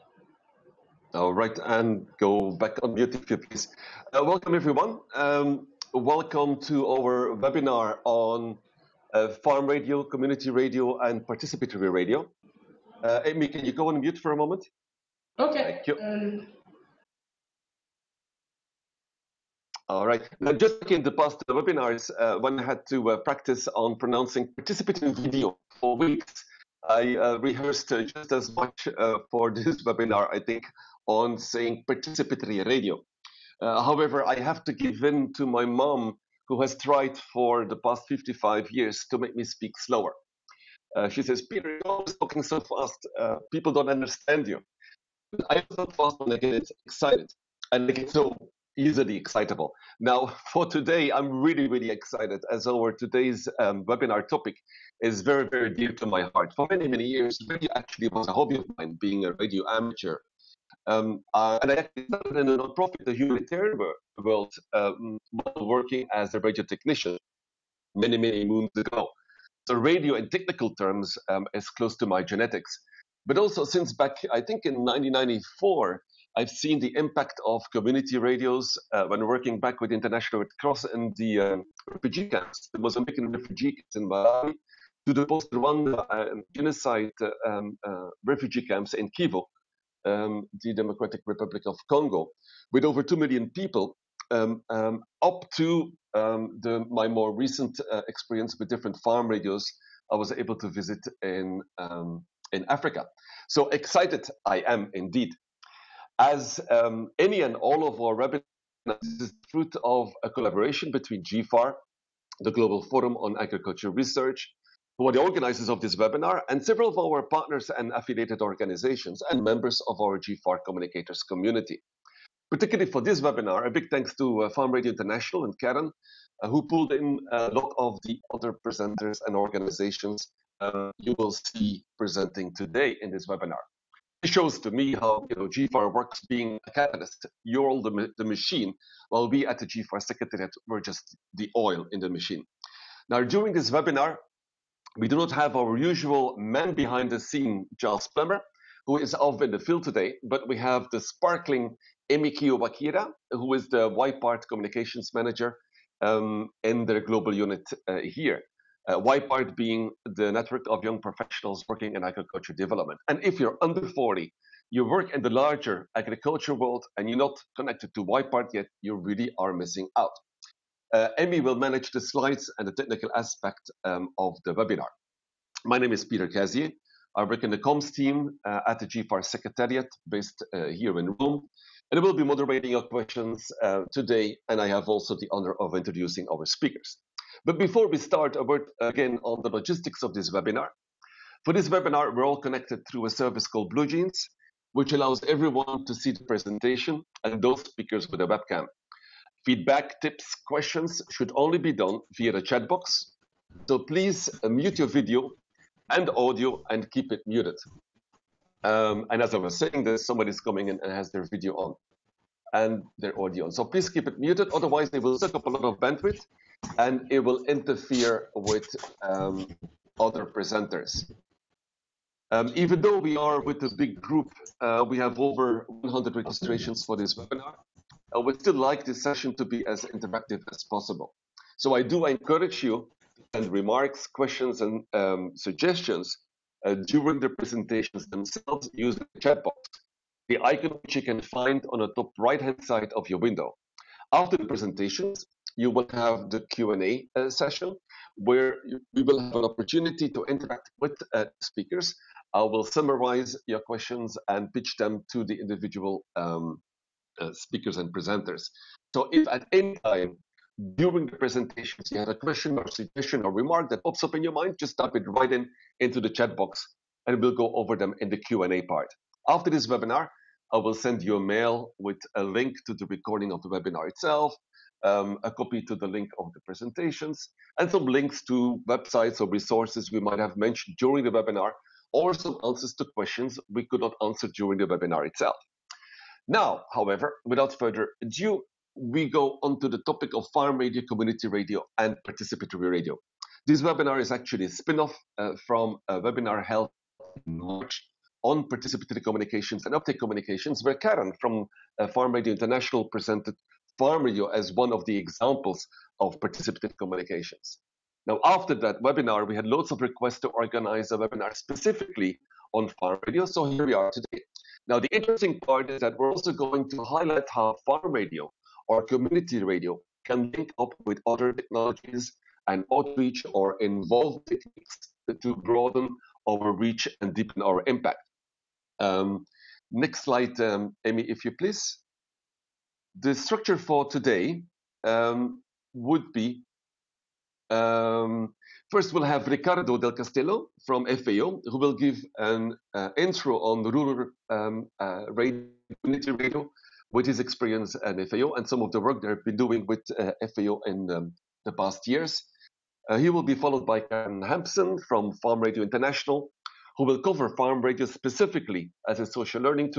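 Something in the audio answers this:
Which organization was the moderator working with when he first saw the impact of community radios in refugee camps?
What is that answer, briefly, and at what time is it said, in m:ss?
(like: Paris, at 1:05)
International Red Cross, at 1:19.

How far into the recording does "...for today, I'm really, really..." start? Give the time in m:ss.
0:50.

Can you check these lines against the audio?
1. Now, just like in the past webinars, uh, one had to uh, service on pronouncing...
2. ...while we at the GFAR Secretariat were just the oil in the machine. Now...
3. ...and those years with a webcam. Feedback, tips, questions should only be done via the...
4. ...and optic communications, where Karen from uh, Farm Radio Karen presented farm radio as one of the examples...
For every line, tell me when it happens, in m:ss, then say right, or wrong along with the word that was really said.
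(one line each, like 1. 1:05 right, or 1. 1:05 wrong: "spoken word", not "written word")
1. 0:20 wrong: "practice", not "service"
2. 2:19 right
3. 3:17 wrong: "speakers", not "years"
4. 4:59 wrong: "International", not "Karen".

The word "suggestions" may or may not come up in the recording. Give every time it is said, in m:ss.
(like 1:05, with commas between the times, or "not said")
3:55, 4:22.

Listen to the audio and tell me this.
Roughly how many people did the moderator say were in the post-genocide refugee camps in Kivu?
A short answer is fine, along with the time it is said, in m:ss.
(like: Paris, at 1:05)
over 2 million, at 1:32.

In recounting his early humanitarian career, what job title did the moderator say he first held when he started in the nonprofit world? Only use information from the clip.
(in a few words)
radio technician.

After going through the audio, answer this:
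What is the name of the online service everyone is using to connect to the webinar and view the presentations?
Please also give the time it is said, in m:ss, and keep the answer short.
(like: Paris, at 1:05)
BlueJeans, at 3:13.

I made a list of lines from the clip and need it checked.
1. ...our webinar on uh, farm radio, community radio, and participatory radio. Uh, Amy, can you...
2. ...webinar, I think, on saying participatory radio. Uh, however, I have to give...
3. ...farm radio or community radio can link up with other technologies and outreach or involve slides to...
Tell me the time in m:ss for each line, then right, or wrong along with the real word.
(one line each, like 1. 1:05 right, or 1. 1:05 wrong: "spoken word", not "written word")
1. 0:06 right
2. 0:29 right
3. 5:17 wrong: "techniques", not "slides".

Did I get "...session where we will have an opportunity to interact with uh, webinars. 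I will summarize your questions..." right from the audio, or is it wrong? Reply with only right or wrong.
wrong.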